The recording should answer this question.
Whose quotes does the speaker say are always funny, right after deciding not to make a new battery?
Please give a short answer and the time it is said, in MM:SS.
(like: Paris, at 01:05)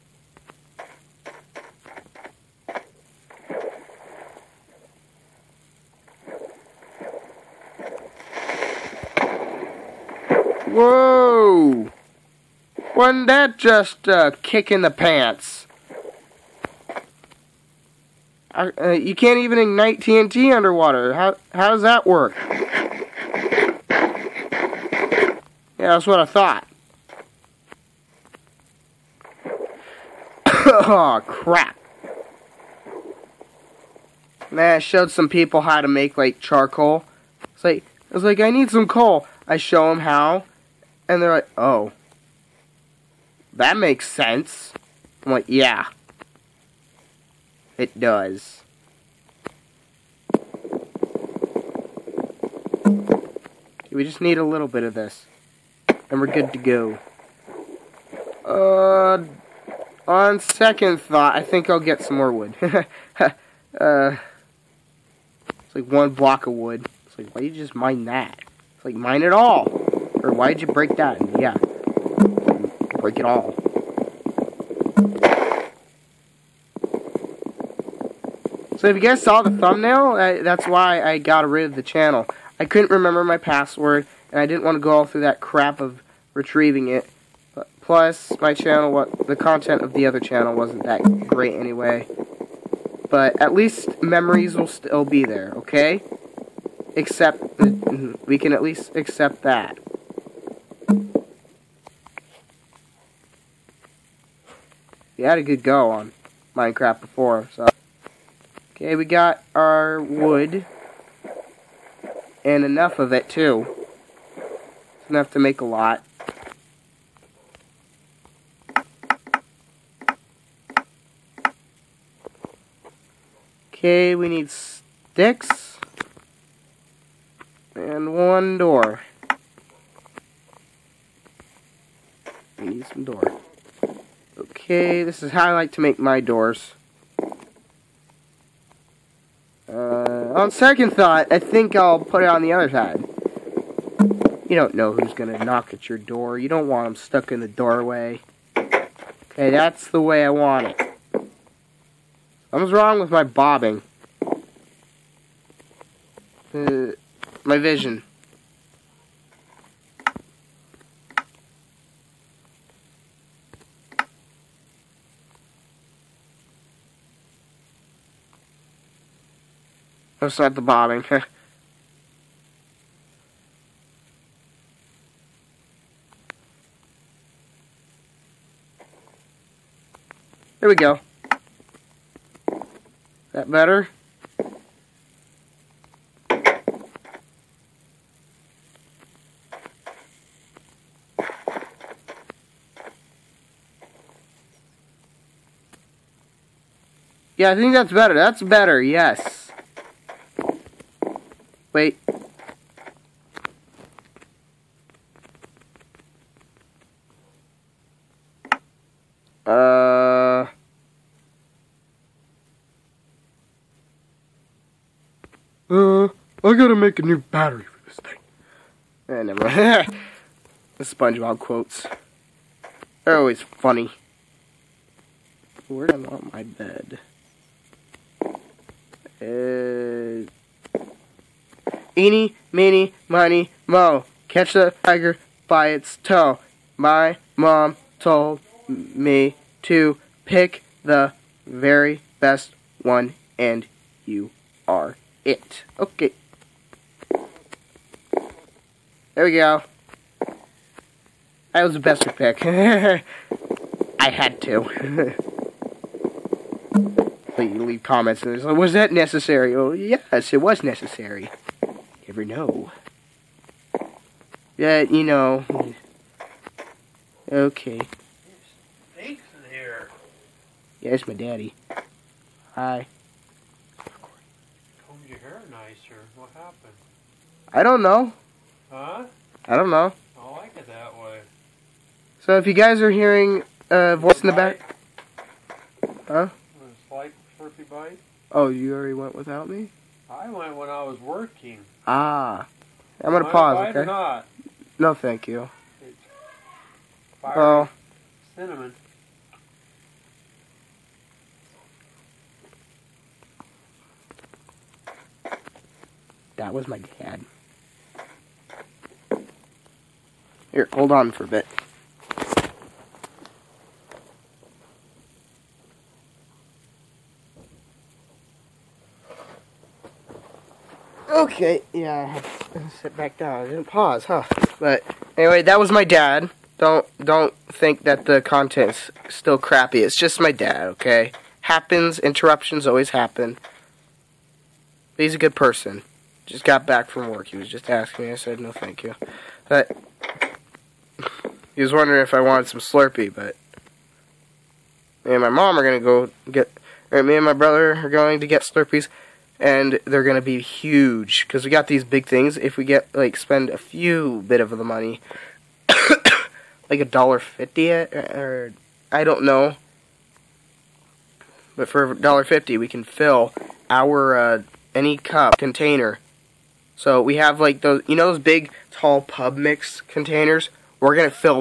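SpongeBob, at 03:40.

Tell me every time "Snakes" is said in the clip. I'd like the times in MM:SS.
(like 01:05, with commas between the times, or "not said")
04:28.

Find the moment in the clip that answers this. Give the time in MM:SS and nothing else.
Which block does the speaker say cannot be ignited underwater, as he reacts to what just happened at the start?
00:19.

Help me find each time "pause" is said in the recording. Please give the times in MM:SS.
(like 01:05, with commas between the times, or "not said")
04:53, 05:23.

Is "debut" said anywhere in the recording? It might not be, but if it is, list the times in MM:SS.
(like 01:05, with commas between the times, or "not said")
not said.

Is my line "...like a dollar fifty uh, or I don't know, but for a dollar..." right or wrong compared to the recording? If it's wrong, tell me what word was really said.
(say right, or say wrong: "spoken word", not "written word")
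right.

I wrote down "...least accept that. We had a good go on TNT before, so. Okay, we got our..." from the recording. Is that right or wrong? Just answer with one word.
wrong.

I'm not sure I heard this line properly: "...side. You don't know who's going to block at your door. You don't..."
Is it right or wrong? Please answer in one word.
wrong.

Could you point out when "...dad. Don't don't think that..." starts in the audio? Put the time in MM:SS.
05:25.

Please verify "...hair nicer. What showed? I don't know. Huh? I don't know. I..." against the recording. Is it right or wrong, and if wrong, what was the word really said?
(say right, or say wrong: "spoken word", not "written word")
wrong: "happened", not "showed".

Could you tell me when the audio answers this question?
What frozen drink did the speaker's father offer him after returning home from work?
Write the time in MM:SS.
05:42.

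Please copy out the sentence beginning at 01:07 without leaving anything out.
It's like, why do you just mine that?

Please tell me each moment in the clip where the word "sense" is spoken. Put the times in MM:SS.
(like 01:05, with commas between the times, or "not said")
00:44.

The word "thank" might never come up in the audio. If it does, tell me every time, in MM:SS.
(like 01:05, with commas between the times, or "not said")
04:54, 05:38.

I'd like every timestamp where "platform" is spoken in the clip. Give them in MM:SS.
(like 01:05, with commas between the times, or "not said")
not said.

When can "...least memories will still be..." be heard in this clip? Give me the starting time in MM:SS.
01:33.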